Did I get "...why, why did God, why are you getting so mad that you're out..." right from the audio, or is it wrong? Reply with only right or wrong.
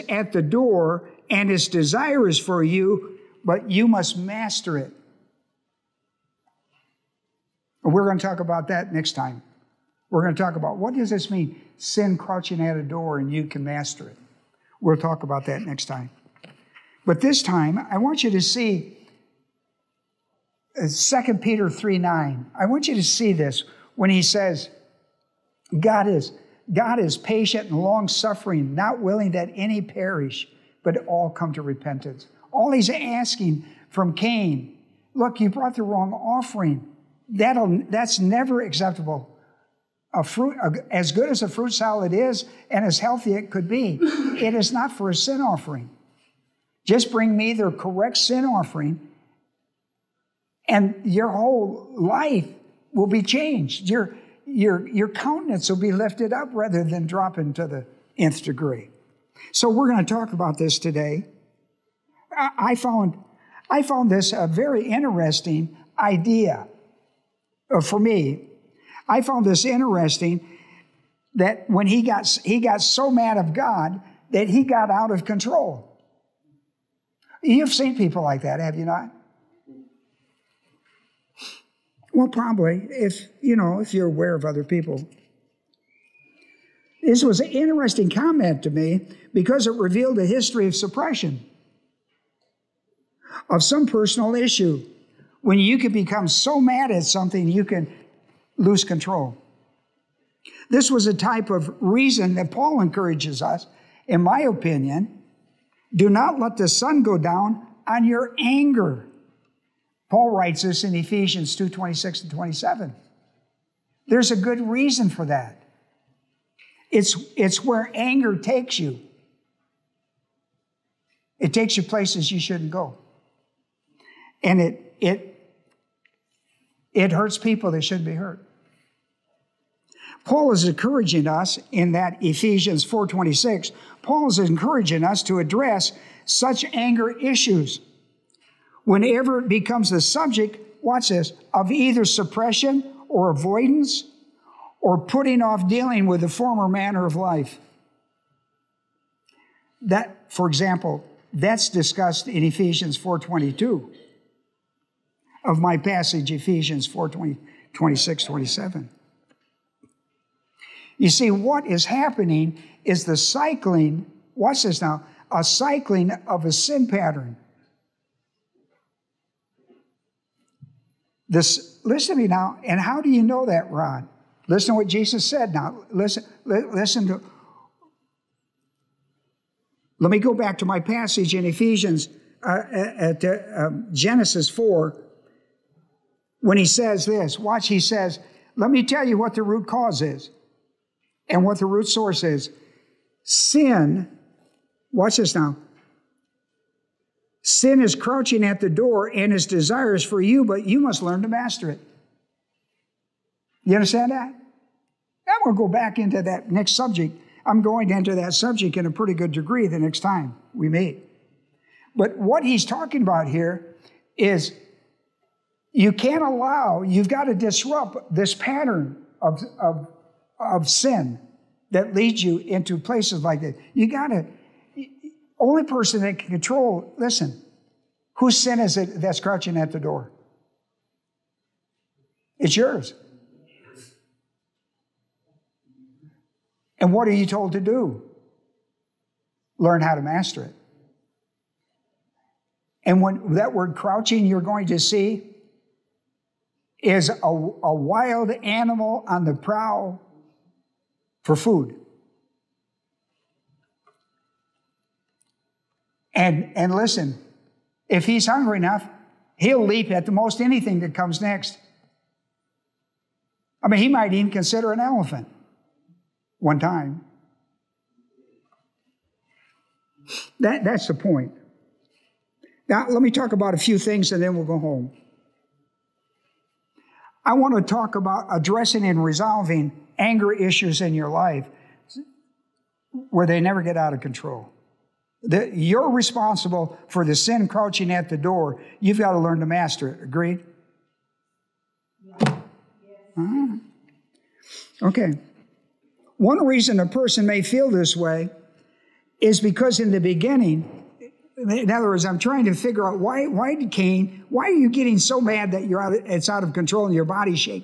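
wrong.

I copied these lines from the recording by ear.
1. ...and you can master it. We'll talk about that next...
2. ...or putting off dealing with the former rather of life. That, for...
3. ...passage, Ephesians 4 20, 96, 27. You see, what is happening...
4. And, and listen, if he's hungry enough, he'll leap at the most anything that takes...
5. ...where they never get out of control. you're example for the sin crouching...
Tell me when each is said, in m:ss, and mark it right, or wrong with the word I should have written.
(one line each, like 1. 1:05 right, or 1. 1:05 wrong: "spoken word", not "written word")
1. 0:13 right
2. 2:24 wrong: "manner", not "rather"
3. 2:35 wrong: "26", not "96"
4. 4:16 wrong: "comes", not "takes"
5. 4:43 wrong: "responsible", not "example".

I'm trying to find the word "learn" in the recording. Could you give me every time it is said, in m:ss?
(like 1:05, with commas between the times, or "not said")
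3:21, 3:59, 4:49.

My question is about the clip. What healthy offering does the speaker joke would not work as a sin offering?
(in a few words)
A fruit salad.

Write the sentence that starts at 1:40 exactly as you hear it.
This was a type of reason that Paul encourages us, in my opinion.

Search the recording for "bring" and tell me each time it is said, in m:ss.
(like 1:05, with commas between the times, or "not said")
0:47.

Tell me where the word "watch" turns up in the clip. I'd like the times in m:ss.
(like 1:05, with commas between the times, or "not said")
2:20, 2:44, 3:07, 3:14.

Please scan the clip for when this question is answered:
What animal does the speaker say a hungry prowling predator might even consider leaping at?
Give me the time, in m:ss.
4:24.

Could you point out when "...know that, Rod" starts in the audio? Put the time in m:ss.
2:53.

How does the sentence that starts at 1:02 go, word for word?
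I, I, found, I found this a very interesting idea.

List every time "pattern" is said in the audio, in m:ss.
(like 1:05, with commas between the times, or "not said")
2:46, 3:38.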